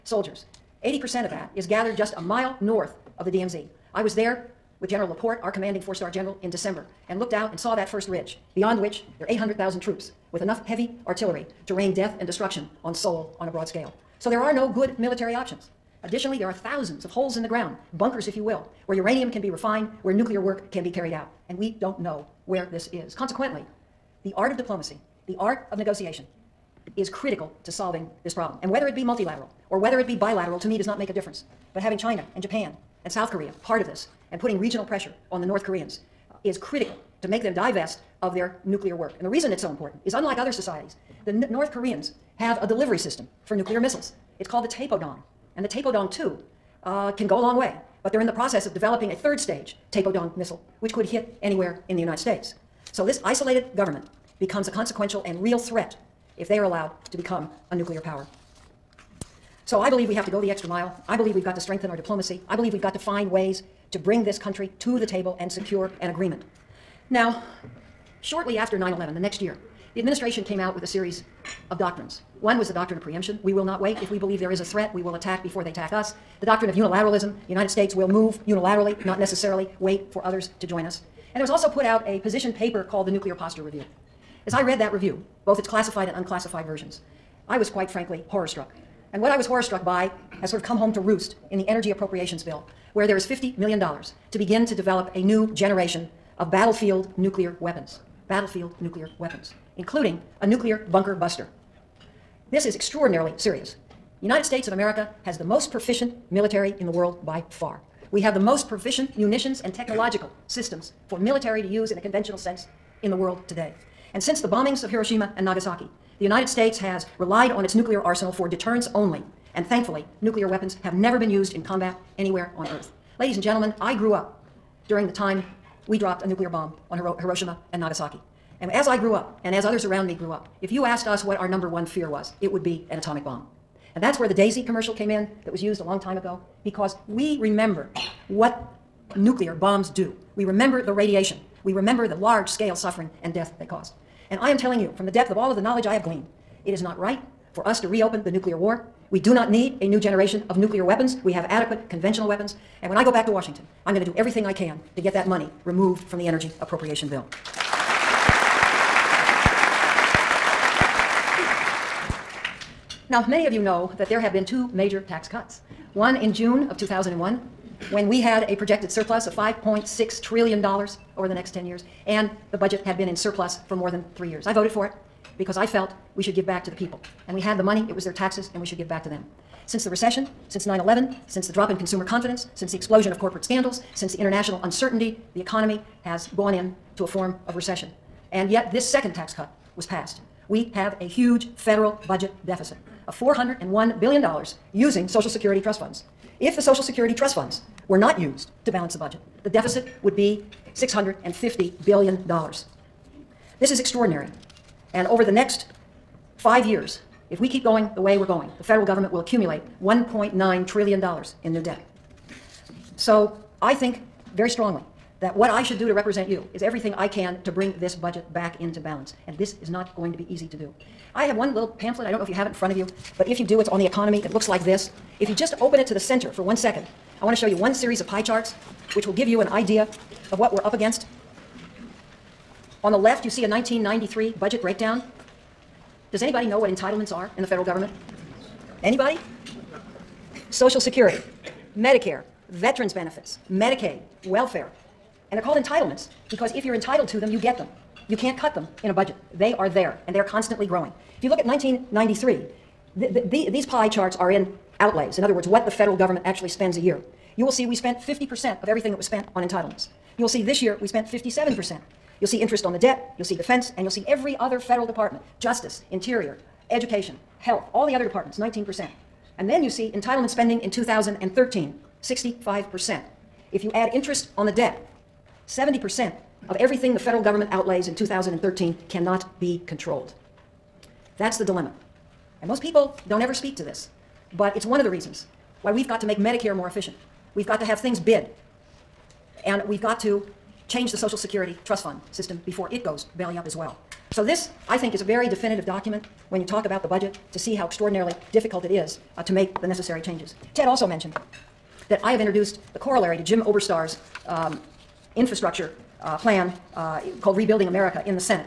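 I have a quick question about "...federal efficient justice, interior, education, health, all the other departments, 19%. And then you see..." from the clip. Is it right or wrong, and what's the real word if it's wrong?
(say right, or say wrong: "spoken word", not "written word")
wrong: "department", not "efficient".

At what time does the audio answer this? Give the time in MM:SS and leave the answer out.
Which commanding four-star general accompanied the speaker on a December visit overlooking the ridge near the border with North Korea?
00:04.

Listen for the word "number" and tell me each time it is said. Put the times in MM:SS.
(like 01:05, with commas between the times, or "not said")
02:11.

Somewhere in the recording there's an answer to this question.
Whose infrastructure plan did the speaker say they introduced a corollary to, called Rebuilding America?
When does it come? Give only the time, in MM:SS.
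05:03.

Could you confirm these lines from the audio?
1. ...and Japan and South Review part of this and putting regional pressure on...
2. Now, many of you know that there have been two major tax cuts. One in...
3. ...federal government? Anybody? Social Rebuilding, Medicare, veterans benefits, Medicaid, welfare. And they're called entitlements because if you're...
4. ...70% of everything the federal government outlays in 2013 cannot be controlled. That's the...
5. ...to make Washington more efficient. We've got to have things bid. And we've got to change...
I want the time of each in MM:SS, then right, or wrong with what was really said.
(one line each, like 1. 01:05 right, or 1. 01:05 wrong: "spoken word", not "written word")
1. 00:32 wrong: "Korea", not "Review"
2. 02:43 right
3. 03:57 wrong: "Security", not "Rebuilding"
4. 04:35 right
5. 04:46 wrong: "Medicare", not "Washington".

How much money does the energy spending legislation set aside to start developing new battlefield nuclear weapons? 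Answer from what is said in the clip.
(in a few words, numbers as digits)
$50 million.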